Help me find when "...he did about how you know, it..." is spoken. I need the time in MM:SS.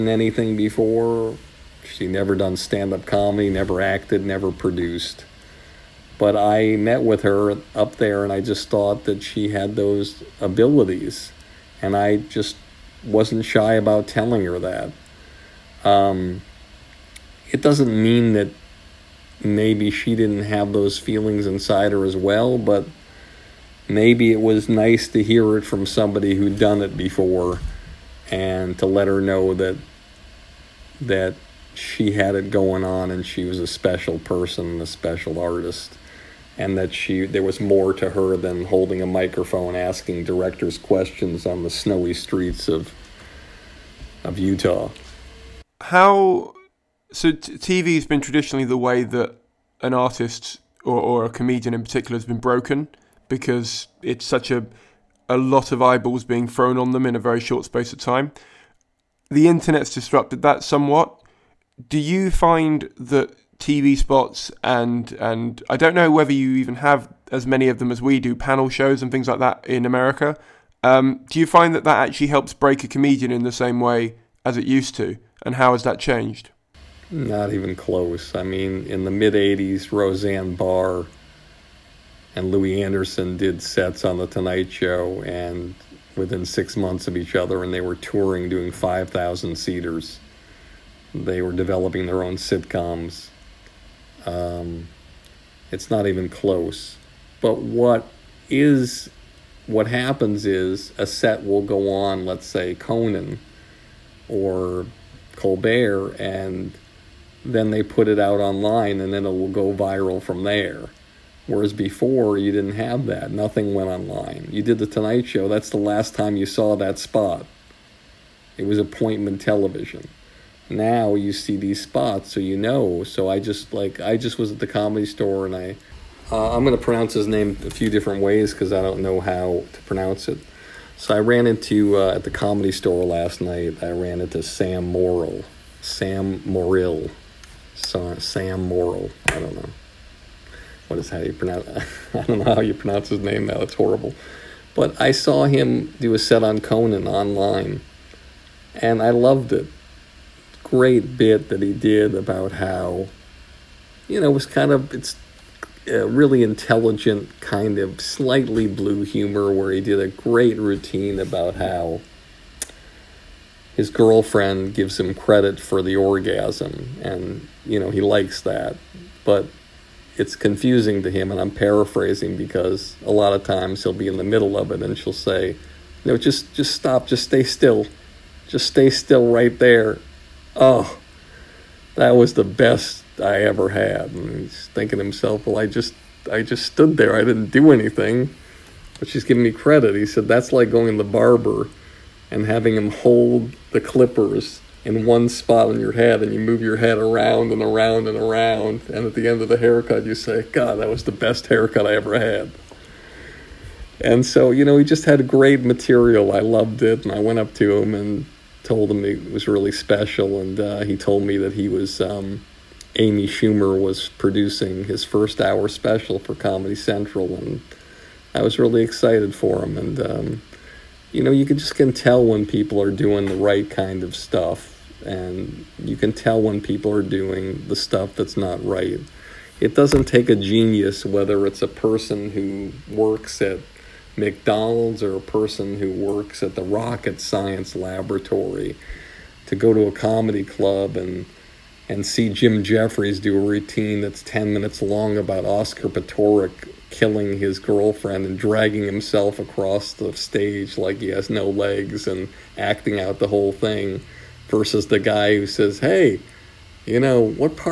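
02:31.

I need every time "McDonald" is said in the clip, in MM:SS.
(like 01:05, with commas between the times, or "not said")
03:54.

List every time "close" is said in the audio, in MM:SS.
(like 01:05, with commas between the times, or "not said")
01:17, 01:36.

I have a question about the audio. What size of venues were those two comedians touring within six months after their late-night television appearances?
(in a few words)
5,000 seaters.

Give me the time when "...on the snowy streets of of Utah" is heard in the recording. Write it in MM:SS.
00:41.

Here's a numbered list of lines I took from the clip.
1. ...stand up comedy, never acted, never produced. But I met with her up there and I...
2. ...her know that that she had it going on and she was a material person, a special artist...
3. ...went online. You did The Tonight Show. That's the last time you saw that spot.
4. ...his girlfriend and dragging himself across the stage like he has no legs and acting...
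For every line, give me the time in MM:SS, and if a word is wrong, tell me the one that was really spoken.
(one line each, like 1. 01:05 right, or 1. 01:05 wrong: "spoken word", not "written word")
1. 00:02 right
2. 00:29 wrong: "special", not "material"
3. 01:53 right
4. 04:07 right.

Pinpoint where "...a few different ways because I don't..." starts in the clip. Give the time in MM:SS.
02:07.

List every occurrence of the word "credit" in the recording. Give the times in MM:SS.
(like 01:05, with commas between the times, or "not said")
02:45, 03:09.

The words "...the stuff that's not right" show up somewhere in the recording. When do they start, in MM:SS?
03:47.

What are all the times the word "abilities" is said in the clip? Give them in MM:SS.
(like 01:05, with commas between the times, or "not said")
00:10.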